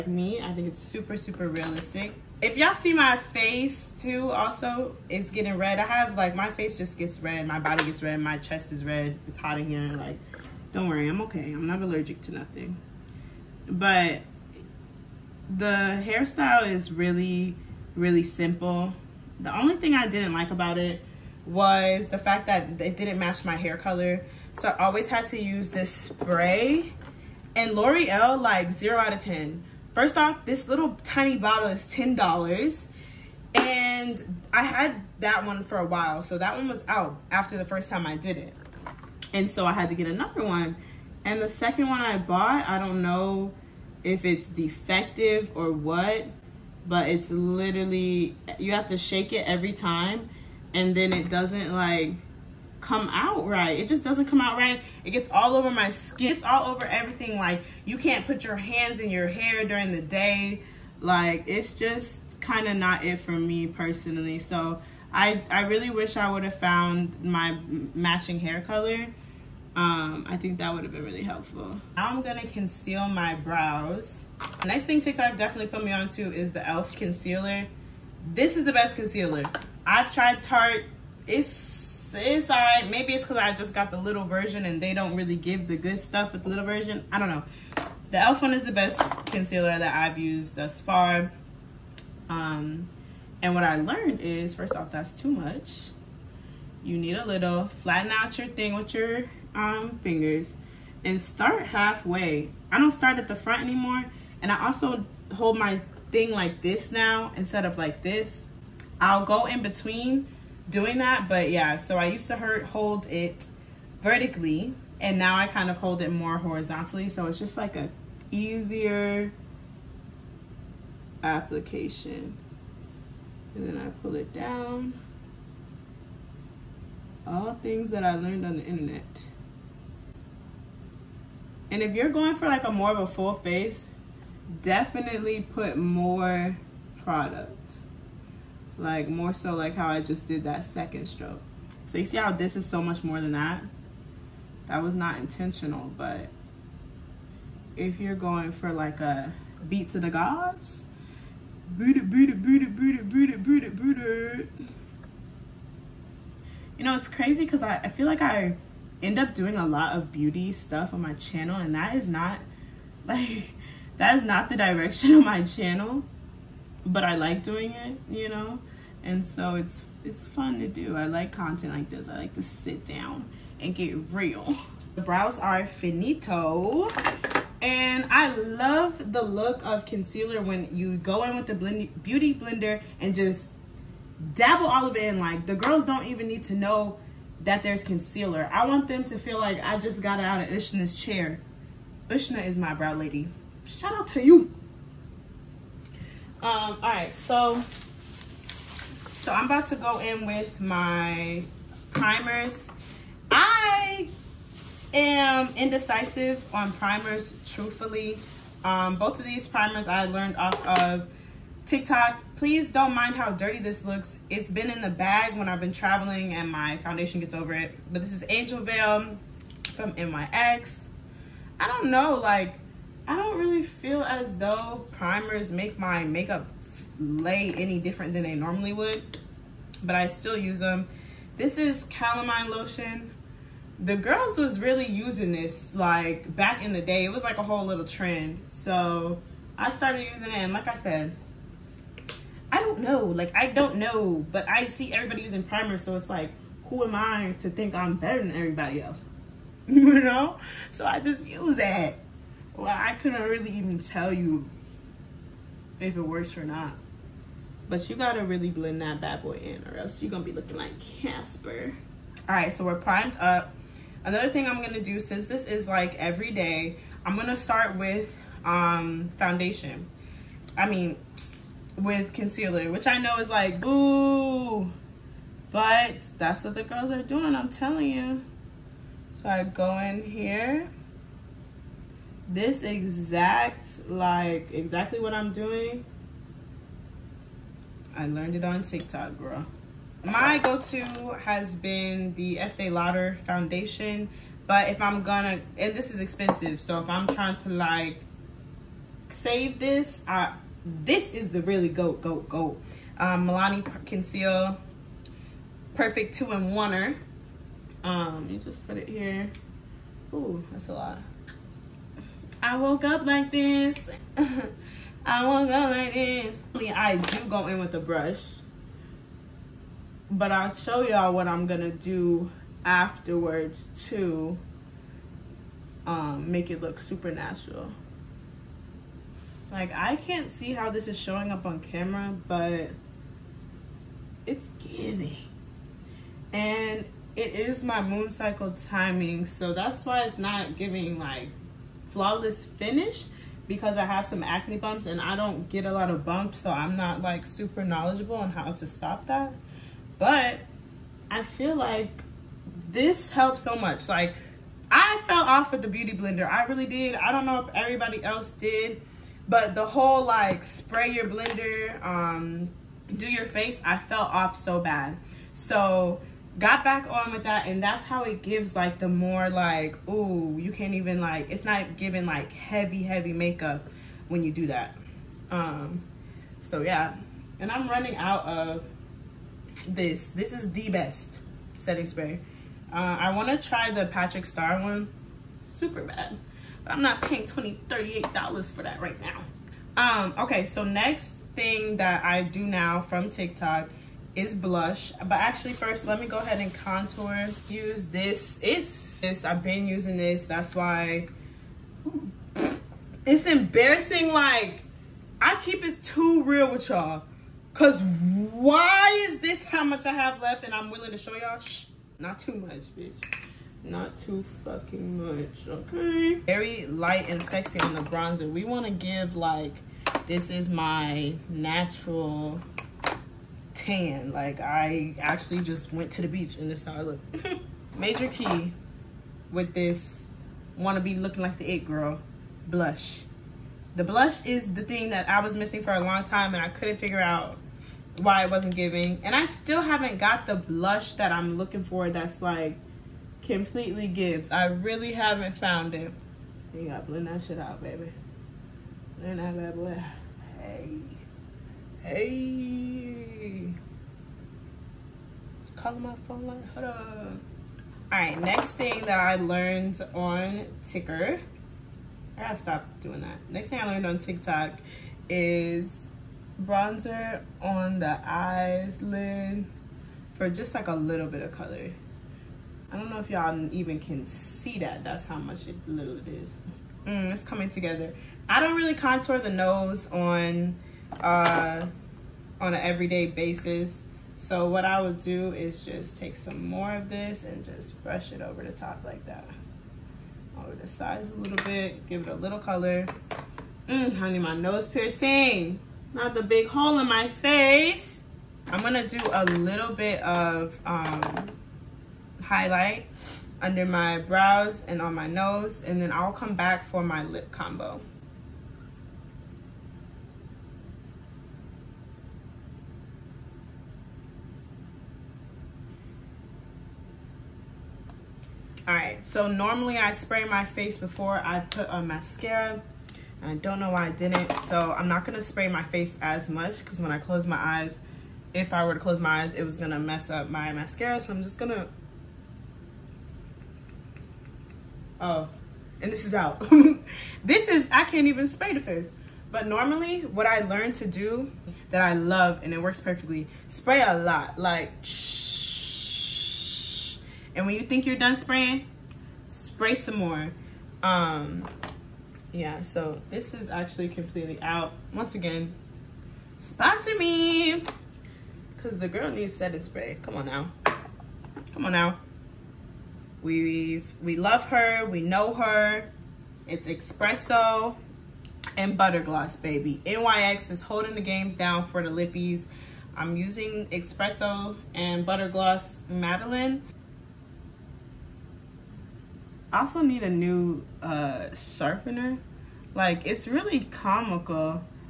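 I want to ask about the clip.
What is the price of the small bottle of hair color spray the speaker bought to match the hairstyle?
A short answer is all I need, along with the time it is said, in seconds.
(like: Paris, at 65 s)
$10, at 31 s.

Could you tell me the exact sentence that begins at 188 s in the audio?
I want them to feel like I just got out of Ushna's chair.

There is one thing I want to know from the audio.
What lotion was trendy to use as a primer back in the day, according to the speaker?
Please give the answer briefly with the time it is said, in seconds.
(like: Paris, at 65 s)
Calamine Lotion, at 231 s.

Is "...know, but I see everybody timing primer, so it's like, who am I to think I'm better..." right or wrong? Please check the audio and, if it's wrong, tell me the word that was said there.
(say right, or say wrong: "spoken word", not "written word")
wrong: "using", not "timing".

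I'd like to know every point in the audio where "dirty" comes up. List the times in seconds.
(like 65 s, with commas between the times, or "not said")
213 s.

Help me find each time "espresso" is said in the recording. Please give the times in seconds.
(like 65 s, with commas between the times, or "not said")
566 s, 573 s.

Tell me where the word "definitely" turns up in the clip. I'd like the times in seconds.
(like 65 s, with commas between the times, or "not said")
75 s, 134 s.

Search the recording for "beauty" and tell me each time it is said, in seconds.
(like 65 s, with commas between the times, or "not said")
160 s, 182 s, 355 s.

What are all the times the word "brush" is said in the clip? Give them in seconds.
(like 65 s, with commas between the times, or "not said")
317 s, 487 s.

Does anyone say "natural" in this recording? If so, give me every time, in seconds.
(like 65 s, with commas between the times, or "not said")
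327 s, 421 s.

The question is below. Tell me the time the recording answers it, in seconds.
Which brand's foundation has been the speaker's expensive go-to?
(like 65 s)
292 s.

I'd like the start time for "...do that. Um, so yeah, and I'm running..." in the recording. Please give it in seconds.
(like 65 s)
374 s.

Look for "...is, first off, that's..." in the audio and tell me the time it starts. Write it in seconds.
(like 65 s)
94 s.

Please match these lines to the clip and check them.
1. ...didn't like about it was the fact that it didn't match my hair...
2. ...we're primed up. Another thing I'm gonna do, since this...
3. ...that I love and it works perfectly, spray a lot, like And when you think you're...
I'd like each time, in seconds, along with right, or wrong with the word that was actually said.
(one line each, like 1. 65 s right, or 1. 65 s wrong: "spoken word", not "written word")
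1. 20 s right
2. 262 s right
3. 541 s right.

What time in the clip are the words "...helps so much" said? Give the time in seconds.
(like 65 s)
353 s.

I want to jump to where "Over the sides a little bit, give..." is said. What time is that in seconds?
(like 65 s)
490 s.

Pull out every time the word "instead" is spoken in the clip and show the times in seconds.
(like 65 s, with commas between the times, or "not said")
107 s.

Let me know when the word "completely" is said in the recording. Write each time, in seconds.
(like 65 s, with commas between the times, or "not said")
443 s, 553 s.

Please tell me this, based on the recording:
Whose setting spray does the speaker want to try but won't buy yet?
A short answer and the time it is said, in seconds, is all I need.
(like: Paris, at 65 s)
Patrick Starrr, at 383 s.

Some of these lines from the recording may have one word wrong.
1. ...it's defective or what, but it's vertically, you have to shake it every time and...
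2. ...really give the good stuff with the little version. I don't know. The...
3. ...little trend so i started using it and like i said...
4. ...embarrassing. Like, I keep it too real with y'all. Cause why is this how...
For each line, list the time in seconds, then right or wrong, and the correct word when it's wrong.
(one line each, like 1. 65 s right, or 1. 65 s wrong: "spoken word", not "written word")
1. 44 s wrong: "literally", not "vertically"
2. 85 s right
3. 237 s right
4. 403 s right.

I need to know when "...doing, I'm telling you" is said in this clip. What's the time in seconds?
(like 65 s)
277 s.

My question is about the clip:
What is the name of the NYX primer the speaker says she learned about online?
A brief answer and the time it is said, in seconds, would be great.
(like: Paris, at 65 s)
Angel Veil, at 218 s.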